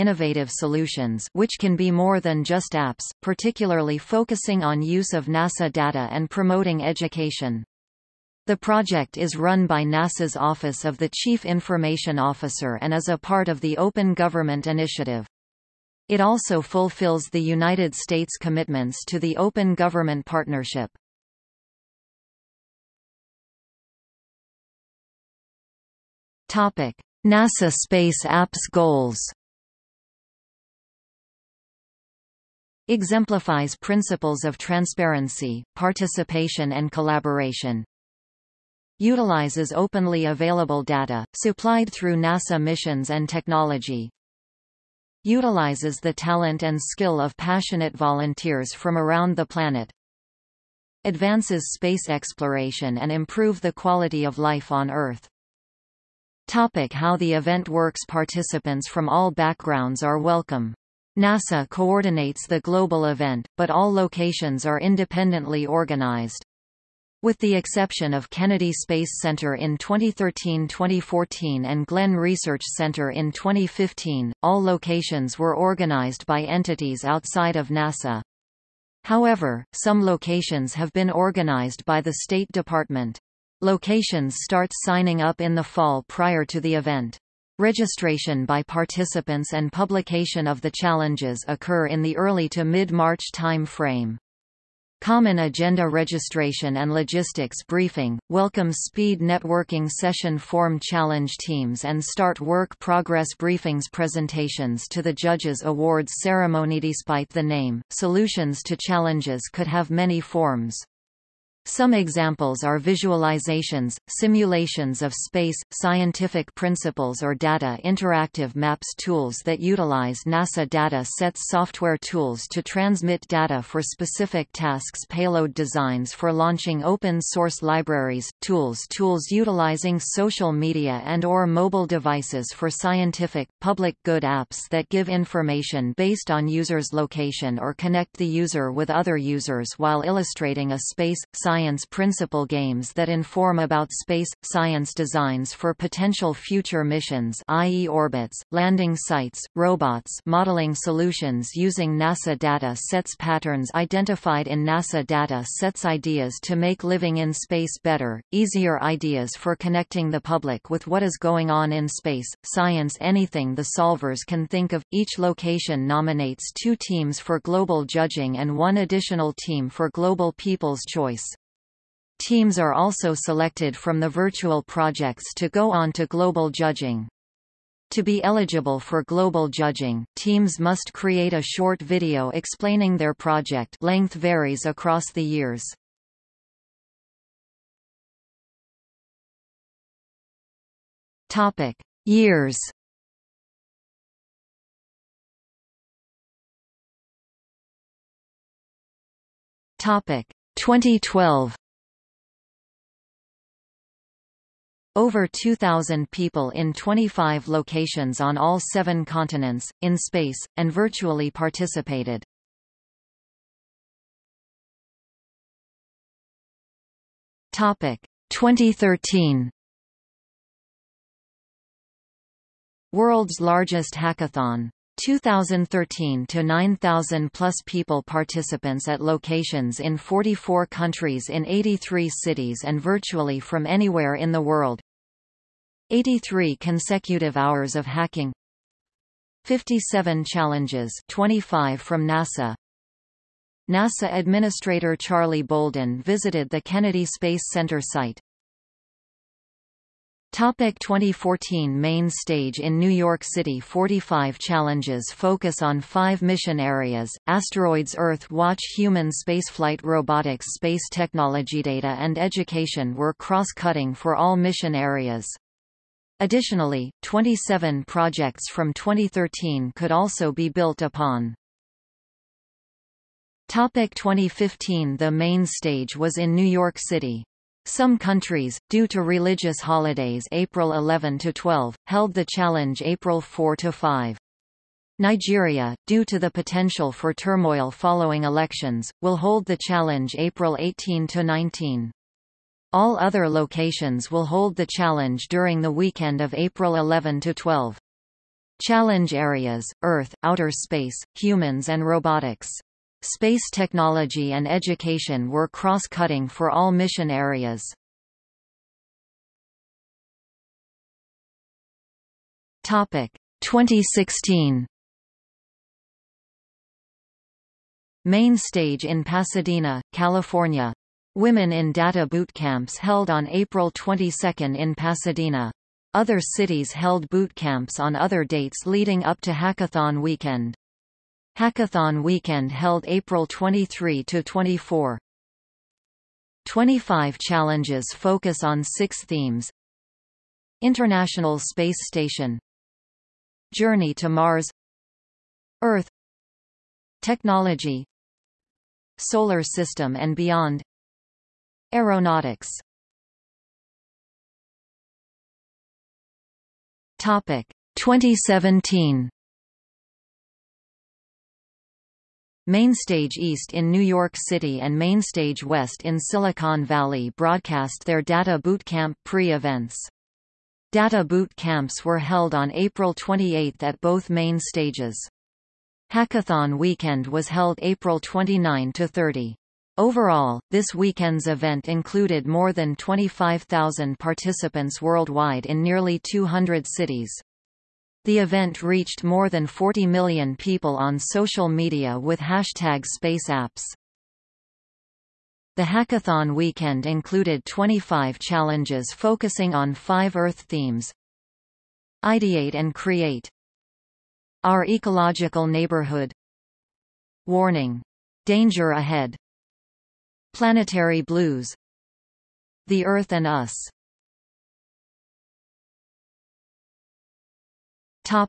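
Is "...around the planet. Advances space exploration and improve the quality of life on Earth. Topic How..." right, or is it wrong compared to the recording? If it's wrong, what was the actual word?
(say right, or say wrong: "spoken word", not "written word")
right.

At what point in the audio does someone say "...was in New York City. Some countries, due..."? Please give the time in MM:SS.
04:35.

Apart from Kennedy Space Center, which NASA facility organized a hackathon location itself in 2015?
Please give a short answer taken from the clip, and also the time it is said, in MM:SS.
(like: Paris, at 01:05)
Glenn Research Center, at 01:11.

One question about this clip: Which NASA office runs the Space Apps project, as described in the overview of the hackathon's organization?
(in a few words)
Office of the Chief Information Officer.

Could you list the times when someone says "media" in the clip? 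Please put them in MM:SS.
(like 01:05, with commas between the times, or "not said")
02:10, 06:31.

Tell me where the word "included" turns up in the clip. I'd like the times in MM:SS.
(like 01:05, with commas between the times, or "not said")
06:21, 06:36.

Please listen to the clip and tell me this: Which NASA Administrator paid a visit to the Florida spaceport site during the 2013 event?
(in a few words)
Charlie Bolden.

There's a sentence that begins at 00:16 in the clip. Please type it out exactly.
It also fulfills the United States' commitments to the Open Government Partnership.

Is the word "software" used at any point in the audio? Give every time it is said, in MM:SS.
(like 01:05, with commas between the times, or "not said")
02:01.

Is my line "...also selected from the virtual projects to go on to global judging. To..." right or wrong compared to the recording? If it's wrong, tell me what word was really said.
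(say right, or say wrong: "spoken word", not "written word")
right.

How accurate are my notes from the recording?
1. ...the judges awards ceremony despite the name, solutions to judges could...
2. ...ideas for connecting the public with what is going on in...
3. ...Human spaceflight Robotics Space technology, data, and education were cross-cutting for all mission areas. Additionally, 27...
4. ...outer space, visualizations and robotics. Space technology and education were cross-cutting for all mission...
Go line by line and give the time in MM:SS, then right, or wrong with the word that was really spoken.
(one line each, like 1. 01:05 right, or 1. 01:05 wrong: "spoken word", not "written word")
1. 01:45 wrong: "challenges", not "judges"
2. 02:38 right
3. 04:18 right
4. 05:00 wrong: "humans", not "visualizations".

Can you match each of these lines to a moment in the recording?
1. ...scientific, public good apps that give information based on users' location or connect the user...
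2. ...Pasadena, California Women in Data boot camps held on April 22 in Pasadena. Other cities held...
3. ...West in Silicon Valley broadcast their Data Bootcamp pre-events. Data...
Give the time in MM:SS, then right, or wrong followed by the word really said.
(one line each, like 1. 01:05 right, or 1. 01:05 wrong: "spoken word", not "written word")
1. 02:12 right
2. 05:19 right
3. 06:05 right.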